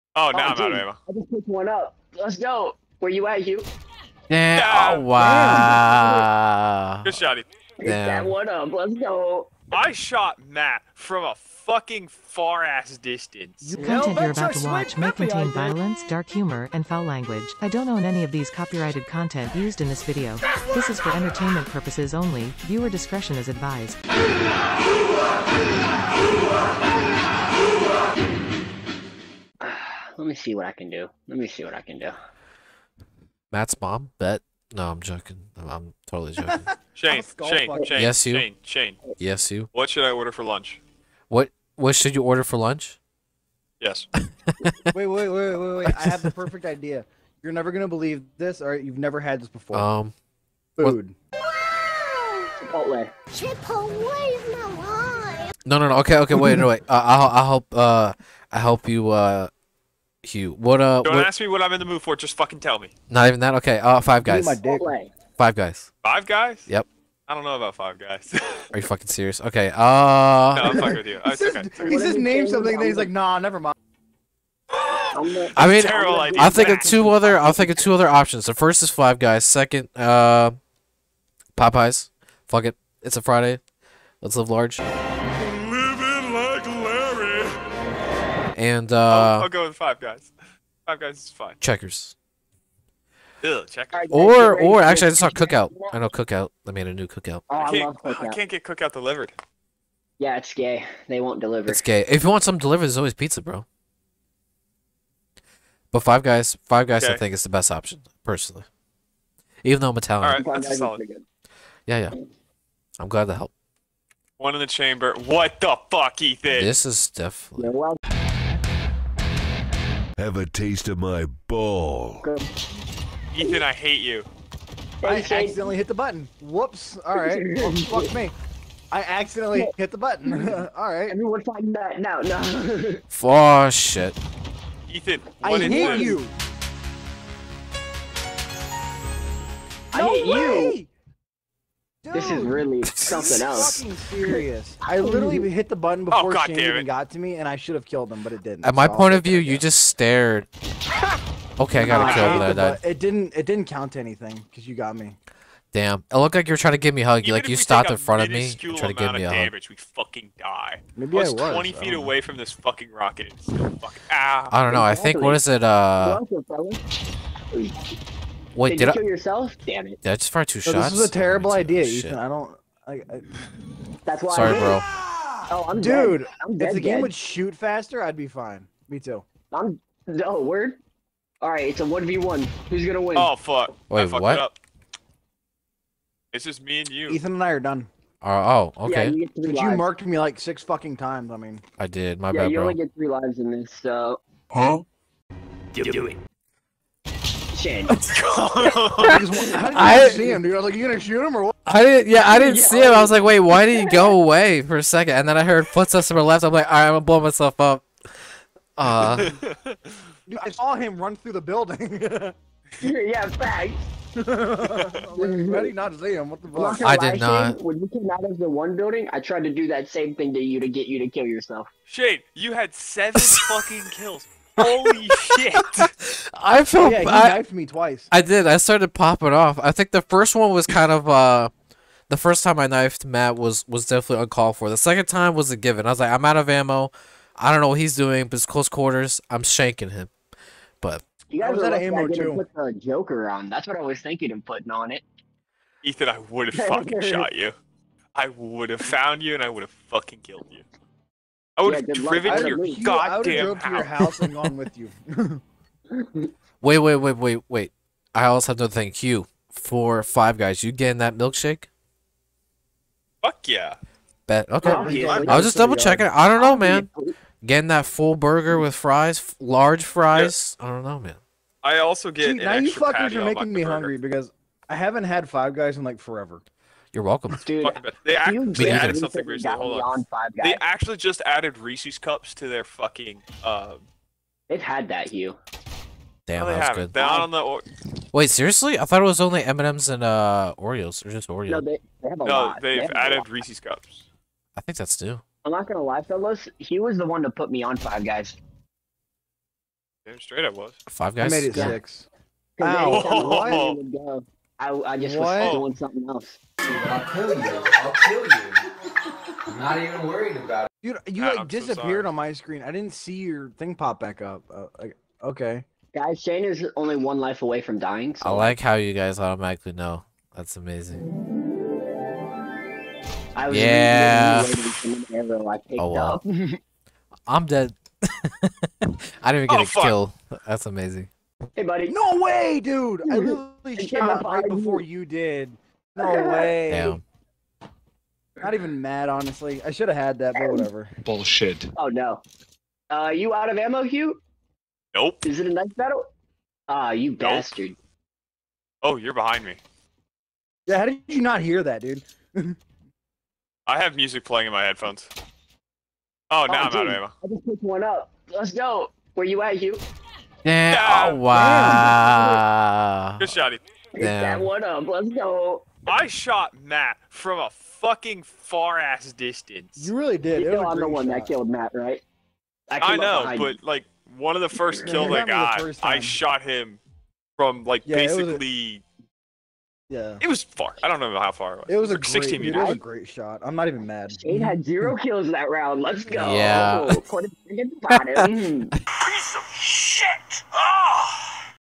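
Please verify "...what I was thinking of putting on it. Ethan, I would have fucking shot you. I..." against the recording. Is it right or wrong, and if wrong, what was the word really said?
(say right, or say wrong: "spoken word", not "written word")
right.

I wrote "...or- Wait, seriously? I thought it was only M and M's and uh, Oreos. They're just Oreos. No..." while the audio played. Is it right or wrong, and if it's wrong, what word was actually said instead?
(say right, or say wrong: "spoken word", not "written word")
right.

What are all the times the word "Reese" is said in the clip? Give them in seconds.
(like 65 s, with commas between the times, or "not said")
281 s, 293 s.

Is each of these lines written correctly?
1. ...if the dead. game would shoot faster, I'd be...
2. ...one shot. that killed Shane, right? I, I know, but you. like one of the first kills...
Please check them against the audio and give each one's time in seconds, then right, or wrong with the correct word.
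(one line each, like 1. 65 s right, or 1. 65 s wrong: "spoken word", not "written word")
1. 176 s right
2. 370 s wrong: "Matt", not "Shane".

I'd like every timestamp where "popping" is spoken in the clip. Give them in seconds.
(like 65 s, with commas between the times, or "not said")
228 s.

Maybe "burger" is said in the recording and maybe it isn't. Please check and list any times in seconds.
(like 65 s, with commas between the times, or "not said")
268 s, 273 s.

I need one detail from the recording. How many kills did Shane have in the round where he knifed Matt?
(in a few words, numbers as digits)
7.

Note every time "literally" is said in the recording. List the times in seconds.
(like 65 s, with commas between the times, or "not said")
144 s, 333 s.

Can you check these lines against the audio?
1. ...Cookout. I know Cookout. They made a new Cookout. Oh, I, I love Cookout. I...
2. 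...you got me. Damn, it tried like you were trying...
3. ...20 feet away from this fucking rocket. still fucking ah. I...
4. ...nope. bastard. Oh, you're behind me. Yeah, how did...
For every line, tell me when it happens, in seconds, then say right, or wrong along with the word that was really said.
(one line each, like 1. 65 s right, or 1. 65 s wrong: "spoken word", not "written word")
1. 95 s right
2. 154 s wrong: "looked", not "tried"
3. 161 s right
4. 347 s right.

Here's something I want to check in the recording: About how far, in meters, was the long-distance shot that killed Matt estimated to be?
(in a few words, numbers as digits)
16 meters.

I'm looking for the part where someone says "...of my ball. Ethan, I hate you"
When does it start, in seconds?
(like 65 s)
120 s.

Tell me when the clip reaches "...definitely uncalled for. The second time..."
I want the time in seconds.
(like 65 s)
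233 s.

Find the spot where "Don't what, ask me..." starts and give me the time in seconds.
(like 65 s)
61 s.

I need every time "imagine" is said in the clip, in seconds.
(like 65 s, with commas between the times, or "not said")
not said.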